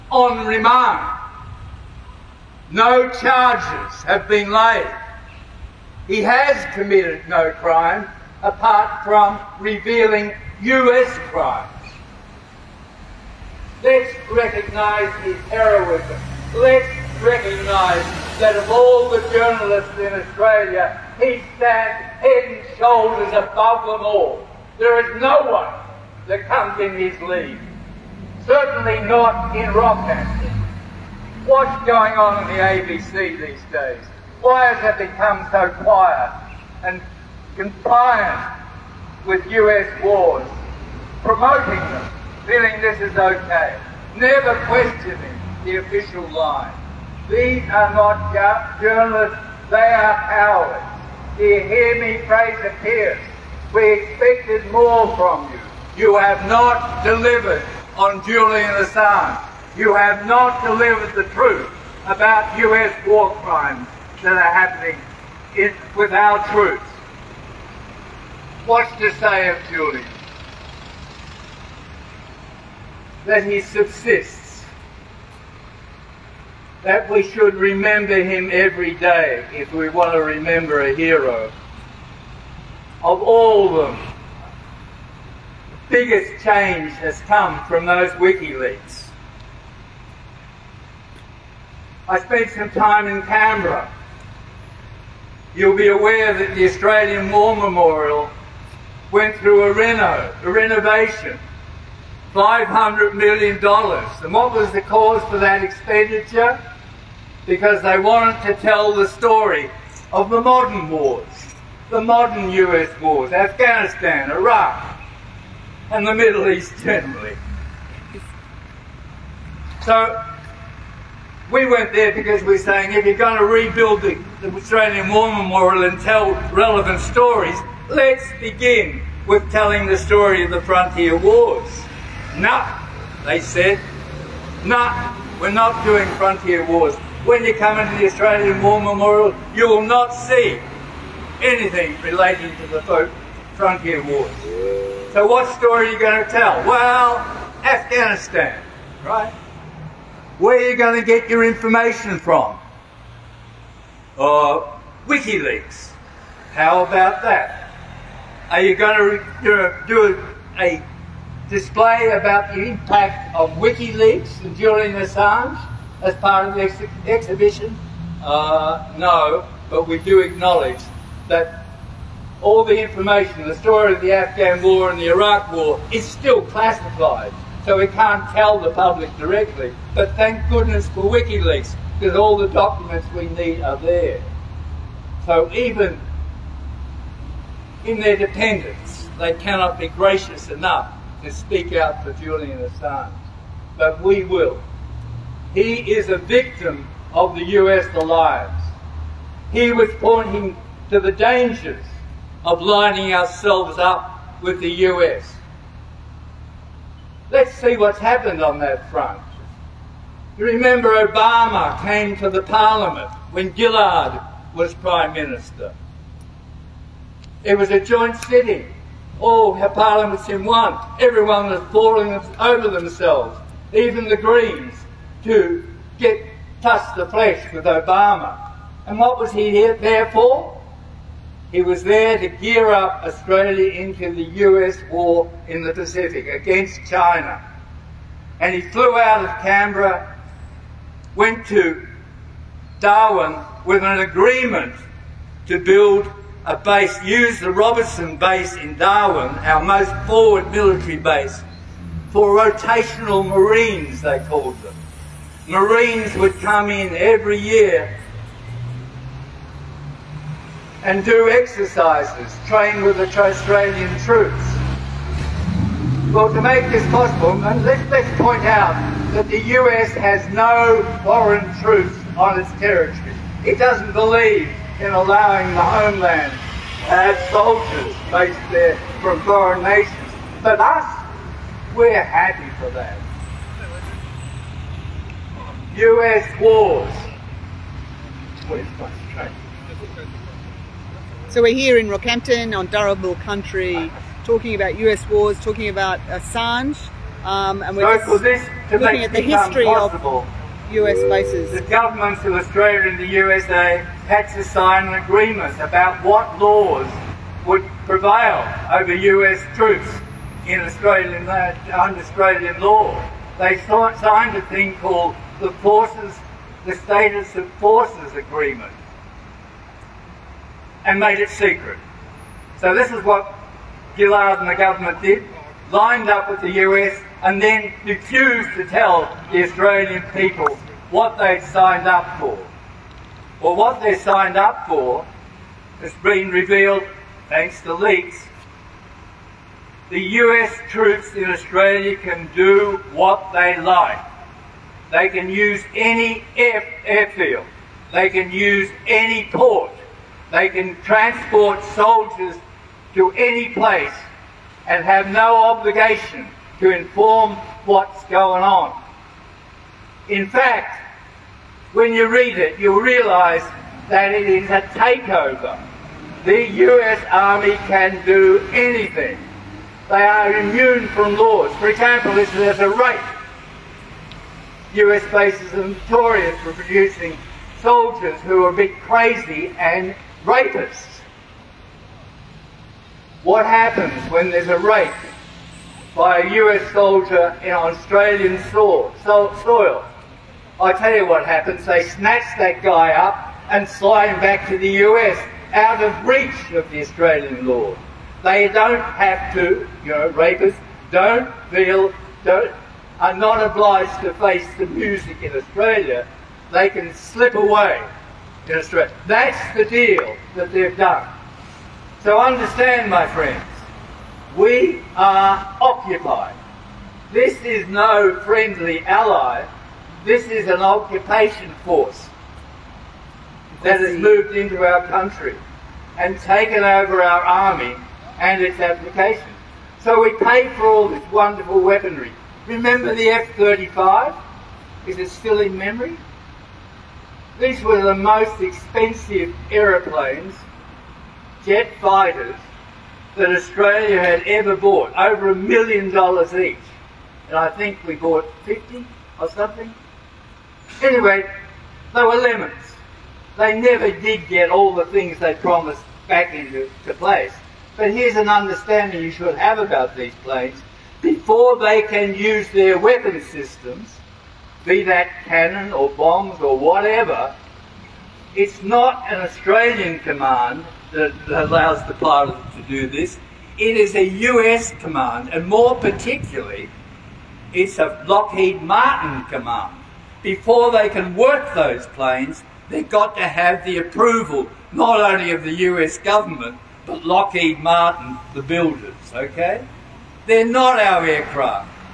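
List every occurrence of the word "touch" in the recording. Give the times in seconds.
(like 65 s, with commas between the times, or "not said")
226 s.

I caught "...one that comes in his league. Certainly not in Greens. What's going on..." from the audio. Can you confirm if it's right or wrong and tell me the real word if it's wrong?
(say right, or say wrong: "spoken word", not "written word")
wrong: "Rockhampton", not "Greens".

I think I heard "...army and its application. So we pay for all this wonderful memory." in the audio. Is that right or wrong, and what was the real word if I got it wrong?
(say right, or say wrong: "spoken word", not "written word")
wrong: "weaponry", not "memory".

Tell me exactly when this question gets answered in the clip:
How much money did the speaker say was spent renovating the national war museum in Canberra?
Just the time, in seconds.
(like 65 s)
102 s.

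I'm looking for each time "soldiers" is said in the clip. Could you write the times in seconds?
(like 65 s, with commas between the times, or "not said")
277 s, 351 s, 377 s, 386 s.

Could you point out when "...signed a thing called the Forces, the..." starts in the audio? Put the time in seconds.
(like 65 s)
313 s.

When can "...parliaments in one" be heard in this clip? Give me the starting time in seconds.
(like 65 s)
219 s.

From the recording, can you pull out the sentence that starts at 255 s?
Marines would come in every year and do exercises, train with the Australian troops.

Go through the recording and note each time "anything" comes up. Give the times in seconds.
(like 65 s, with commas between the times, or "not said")
141 s, 368 s.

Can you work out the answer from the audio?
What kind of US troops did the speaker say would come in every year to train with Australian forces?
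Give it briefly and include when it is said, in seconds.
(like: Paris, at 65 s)
rotational Marines, at 252 s.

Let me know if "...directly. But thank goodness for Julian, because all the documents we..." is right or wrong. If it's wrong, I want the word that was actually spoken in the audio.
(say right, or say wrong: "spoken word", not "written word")
wrong: "WikiLeaks", not "Julian".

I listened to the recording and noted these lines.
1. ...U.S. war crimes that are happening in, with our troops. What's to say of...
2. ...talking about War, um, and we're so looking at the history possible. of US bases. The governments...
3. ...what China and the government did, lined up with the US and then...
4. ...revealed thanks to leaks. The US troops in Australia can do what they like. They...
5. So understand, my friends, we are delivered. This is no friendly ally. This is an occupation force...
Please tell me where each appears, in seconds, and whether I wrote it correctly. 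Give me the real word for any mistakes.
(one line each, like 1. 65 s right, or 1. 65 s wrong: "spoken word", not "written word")
1. 62 s right
2. 295 s wrong: "Assange", not "War"
3. 323 s wrong: "Gillard", not "China"
4. 336 s right
5. 412 s wrong: "occupied", not "delivered".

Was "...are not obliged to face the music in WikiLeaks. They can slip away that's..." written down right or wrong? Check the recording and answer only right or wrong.
wrong.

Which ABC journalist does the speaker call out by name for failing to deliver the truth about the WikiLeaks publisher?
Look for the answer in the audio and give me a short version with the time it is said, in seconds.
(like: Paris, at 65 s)
Fraser Pierce, at 52 s.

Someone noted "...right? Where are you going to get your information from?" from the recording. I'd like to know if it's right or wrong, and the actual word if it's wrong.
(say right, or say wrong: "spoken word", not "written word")
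right.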